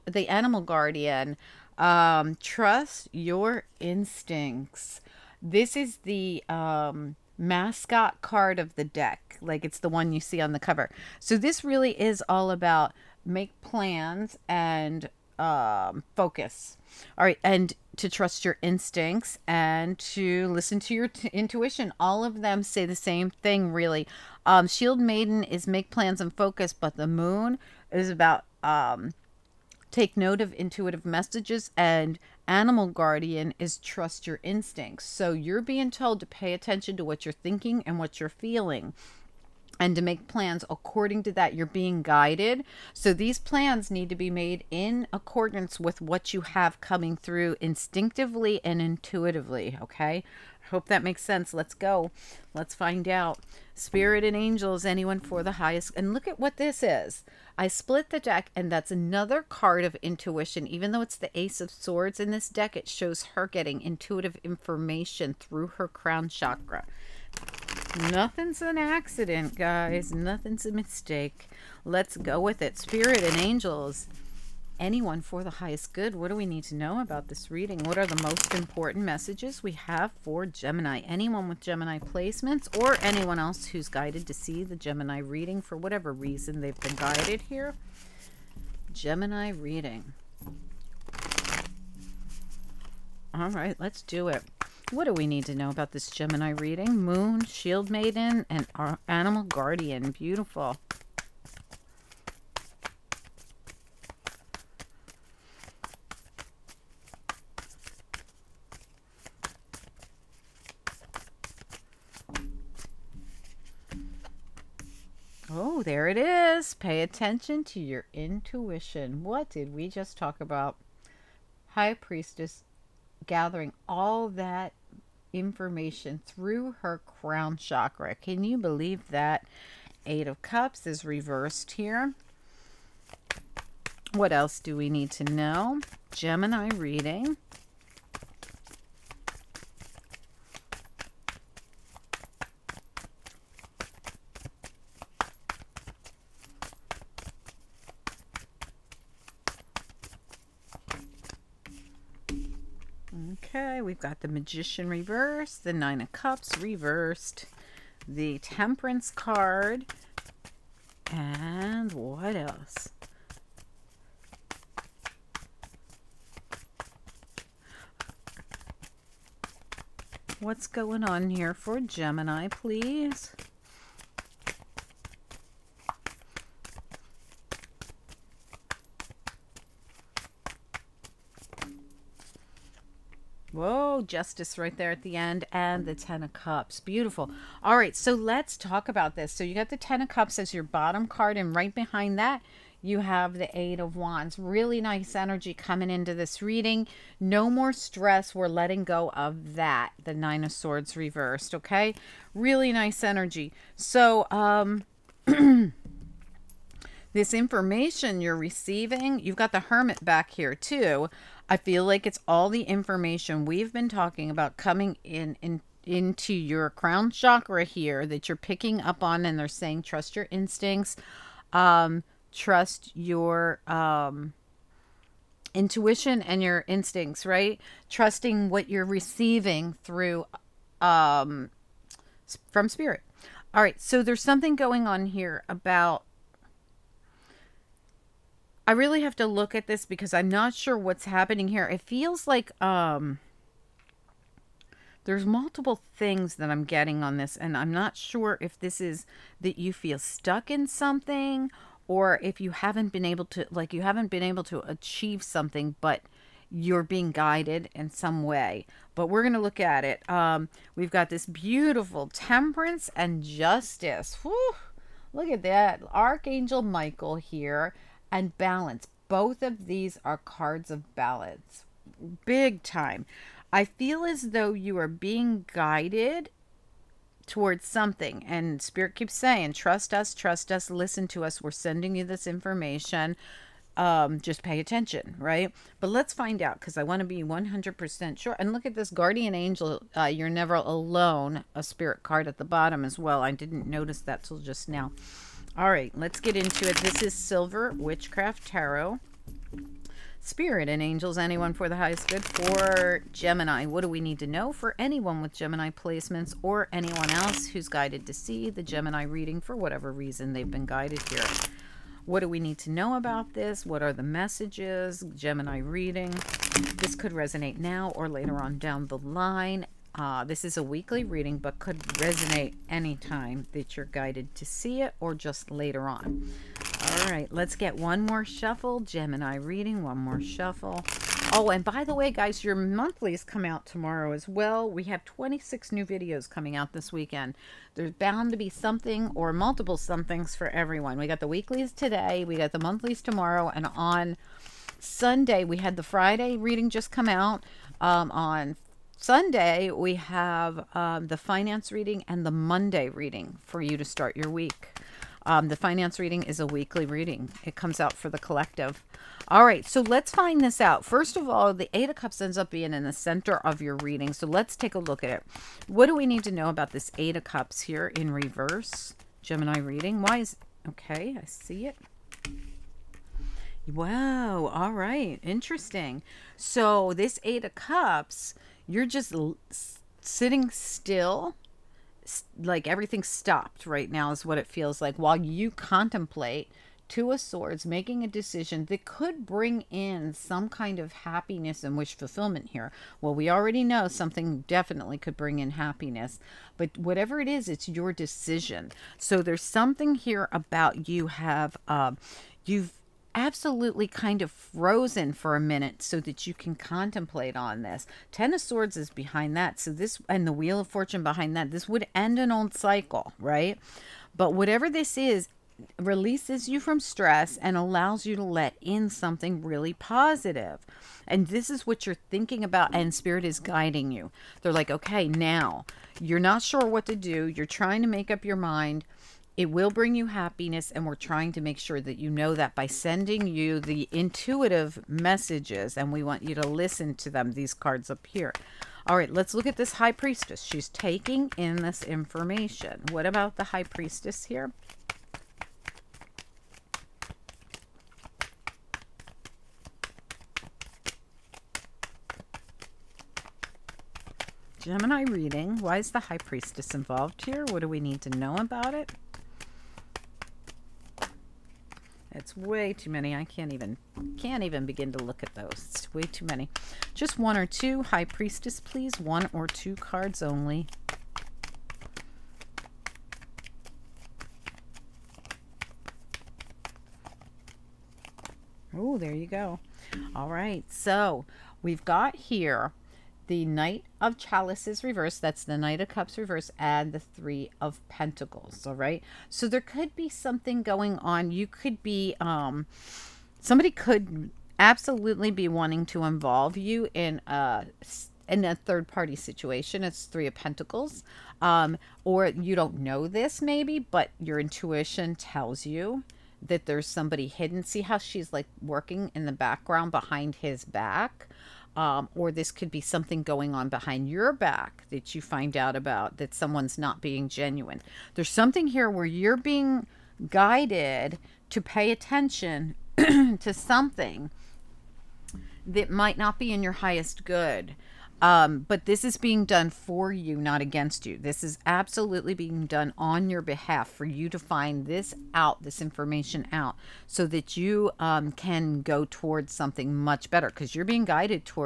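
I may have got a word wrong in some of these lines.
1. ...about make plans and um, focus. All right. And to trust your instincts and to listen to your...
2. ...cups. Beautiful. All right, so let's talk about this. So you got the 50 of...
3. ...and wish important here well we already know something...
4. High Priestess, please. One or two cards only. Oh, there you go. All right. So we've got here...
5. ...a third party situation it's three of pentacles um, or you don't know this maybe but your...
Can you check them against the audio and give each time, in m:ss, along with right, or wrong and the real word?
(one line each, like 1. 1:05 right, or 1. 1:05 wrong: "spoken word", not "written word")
1. 0:12 right
2. 3:06 wrong: "10", not "50"
3. 6:31 wrong: "fulfillment", not "important"
4. 7:47 right
5. 8:18 right.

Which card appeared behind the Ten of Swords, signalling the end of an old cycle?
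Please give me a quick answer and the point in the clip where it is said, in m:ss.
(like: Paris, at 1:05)
Wheel of Fortune, at 6:50.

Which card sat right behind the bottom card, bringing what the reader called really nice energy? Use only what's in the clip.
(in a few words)
Eight of Wands.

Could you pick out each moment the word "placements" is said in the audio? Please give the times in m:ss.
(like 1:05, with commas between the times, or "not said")
1:21, 5:05.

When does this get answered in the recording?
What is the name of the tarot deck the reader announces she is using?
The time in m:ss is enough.
4:57.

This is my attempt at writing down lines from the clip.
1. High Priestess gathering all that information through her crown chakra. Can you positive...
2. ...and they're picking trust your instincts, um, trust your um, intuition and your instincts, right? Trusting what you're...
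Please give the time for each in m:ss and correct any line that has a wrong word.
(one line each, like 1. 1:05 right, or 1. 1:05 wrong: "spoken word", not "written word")
1. 2:01 wrong: "believe", not "positive"
2. 3:39 wrong: "saying", not "picking".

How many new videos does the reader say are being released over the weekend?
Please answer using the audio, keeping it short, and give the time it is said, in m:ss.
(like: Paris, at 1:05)
26, at 5:35.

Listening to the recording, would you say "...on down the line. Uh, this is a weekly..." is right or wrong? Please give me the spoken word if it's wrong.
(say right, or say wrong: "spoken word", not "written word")
right.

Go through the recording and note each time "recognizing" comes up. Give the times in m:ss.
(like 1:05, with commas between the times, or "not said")
not said.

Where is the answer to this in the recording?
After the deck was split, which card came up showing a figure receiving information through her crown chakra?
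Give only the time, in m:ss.
1:01.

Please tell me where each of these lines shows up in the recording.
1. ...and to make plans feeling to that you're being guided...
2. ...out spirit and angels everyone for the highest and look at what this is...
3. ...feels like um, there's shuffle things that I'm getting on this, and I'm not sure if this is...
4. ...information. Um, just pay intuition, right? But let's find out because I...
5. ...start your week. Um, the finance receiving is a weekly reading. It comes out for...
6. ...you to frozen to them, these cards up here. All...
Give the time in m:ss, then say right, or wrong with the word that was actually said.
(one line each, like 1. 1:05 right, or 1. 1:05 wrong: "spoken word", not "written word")
1. 0:39 wrong: "according", not "feeling"
2. 0:53 wrong: "anyone", not "everyone"
3. 4:01 wrong: "multiple", not "shuffle"
4. 4:42 wrong: "attention", not "intuition"
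5. 5:53 wrong: "reading", not "receiving"
6. 7:16 wrong: "listen", not "frozen".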